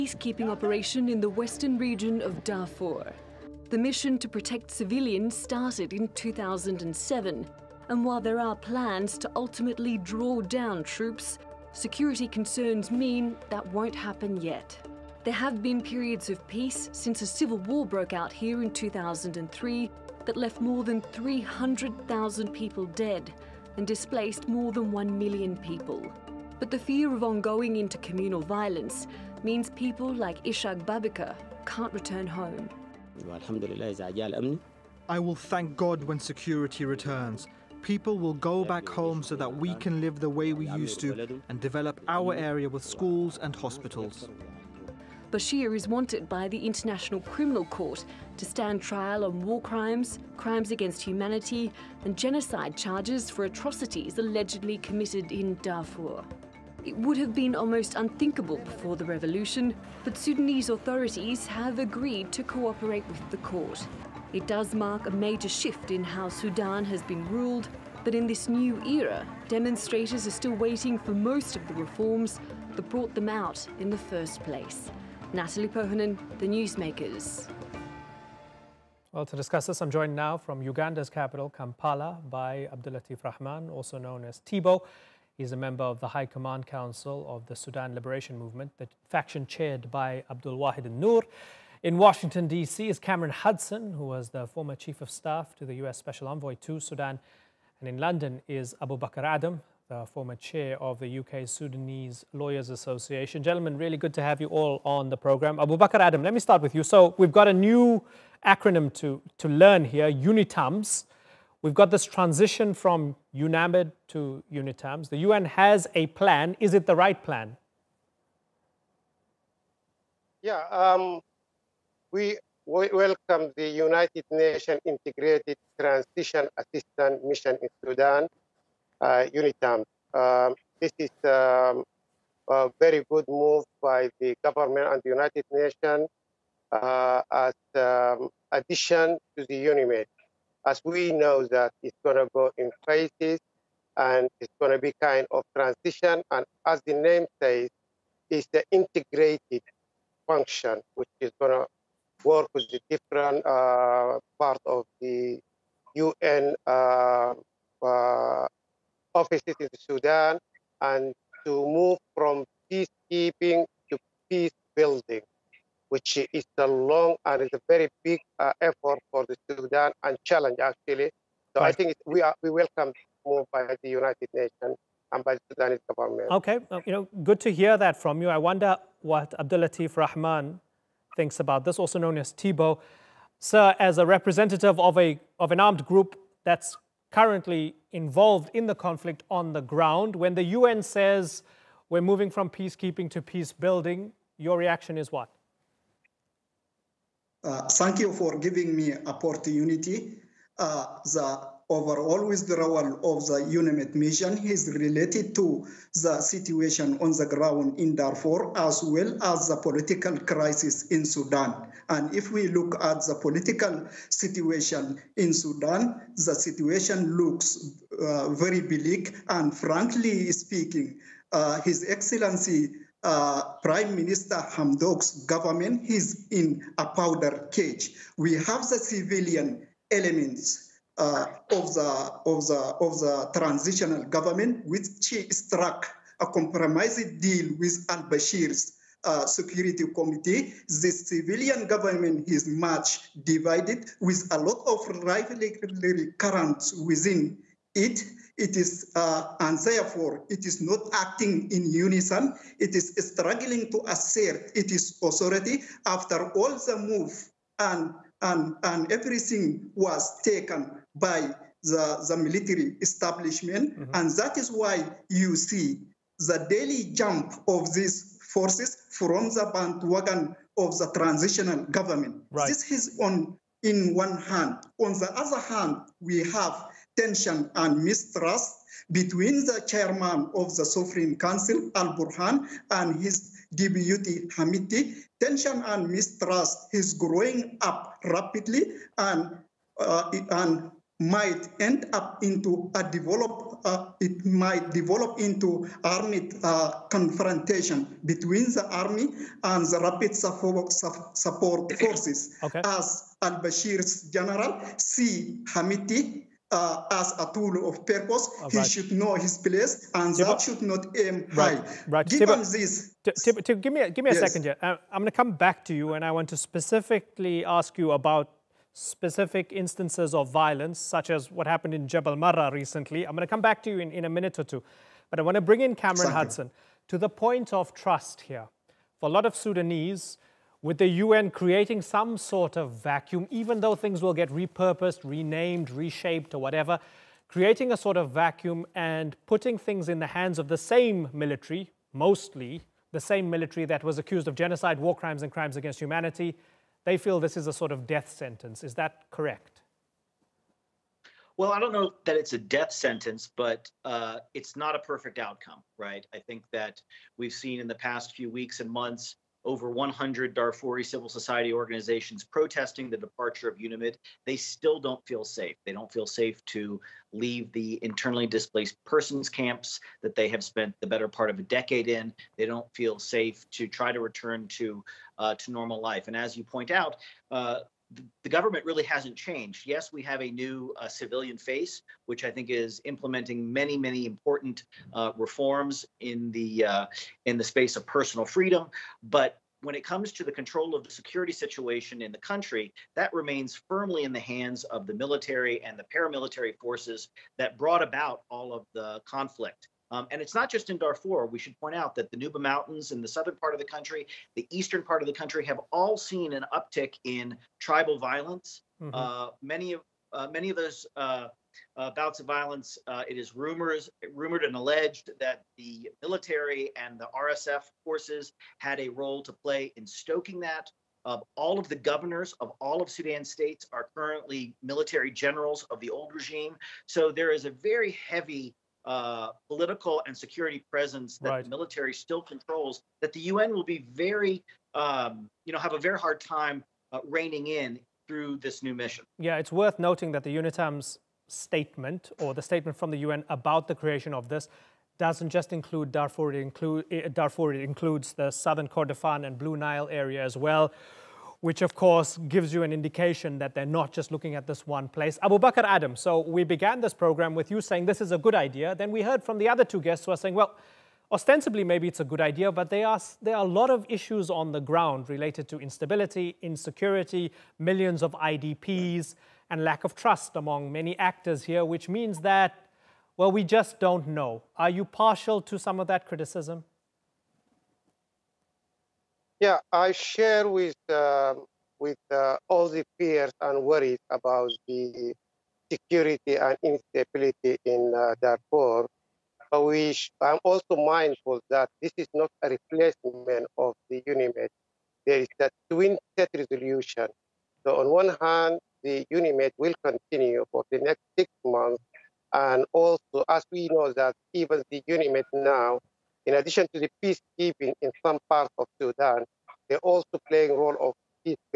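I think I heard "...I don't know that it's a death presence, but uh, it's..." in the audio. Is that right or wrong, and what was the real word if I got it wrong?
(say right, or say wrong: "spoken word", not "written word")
wrong: "sentence", not "presence".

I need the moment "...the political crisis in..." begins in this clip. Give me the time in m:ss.
3:29.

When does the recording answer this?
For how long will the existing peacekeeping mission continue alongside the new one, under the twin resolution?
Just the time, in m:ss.
8:21.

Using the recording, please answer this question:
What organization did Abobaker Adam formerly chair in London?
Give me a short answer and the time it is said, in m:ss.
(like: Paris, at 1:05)
UK Sudanese Lawyers Association, at 1:41.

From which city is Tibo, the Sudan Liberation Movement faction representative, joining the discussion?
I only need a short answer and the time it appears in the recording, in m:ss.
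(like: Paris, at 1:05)
Kampala, at 1:21.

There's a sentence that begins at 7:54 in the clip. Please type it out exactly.
Are you partial to some of that criticism?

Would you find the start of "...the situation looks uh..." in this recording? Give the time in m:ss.
3:36.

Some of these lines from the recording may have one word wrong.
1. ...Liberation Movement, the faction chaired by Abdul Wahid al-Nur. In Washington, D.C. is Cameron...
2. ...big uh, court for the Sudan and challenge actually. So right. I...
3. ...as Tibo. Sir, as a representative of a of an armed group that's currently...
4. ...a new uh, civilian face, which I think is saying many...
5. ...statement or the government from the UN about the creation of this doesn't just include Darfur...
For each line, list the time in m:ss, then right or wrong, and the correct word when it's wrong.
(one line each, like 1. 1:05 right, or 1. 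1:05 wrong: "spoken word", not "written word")
1. 1:27 right
2. 2:48 wrong: "effort", not "court"
3. 3:02 right
4. 6:20 wrong: "implementing", not "saying"
5. 7:21 wrong: "statement", not "government".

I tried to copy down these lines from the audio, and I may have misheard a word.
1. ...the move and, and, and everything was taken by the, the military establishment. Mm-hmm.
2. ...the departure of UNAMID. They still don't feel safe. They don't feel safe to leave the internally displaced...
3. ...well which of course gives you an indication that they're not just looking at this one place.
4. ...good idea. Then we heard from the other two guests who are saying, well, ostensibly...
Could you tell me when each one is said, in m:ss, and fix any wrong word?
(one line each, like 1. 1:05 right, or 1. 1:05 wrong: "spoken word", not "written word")
1. 4:16 right
2. 6:02 right
3. 7:30 right
4. 7:38 right.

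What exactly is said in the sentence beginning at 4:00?
The civilian government is much divided, with a lot of rivalry currents within it.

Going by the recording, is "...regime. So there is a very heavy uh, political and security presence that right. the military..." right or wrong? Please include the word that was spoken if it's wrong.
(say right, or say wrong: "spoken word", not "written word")
right.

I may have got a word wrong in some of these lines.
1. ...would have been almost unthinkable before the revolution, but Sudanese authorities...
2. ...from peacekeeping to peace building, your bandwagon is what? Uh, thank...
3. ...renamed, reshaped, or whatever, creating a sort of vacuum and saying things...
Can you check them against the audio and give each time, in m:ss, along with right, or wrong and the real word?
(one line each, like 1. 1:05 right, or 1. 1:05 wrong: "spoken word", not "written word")
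1. 0:56 right
2. 3:12 wrong: "reaction", not "bandwagon"
3. 5:35 wrong: "putting", not "saying".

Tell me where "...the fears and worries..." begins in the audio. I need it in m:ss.
8:02.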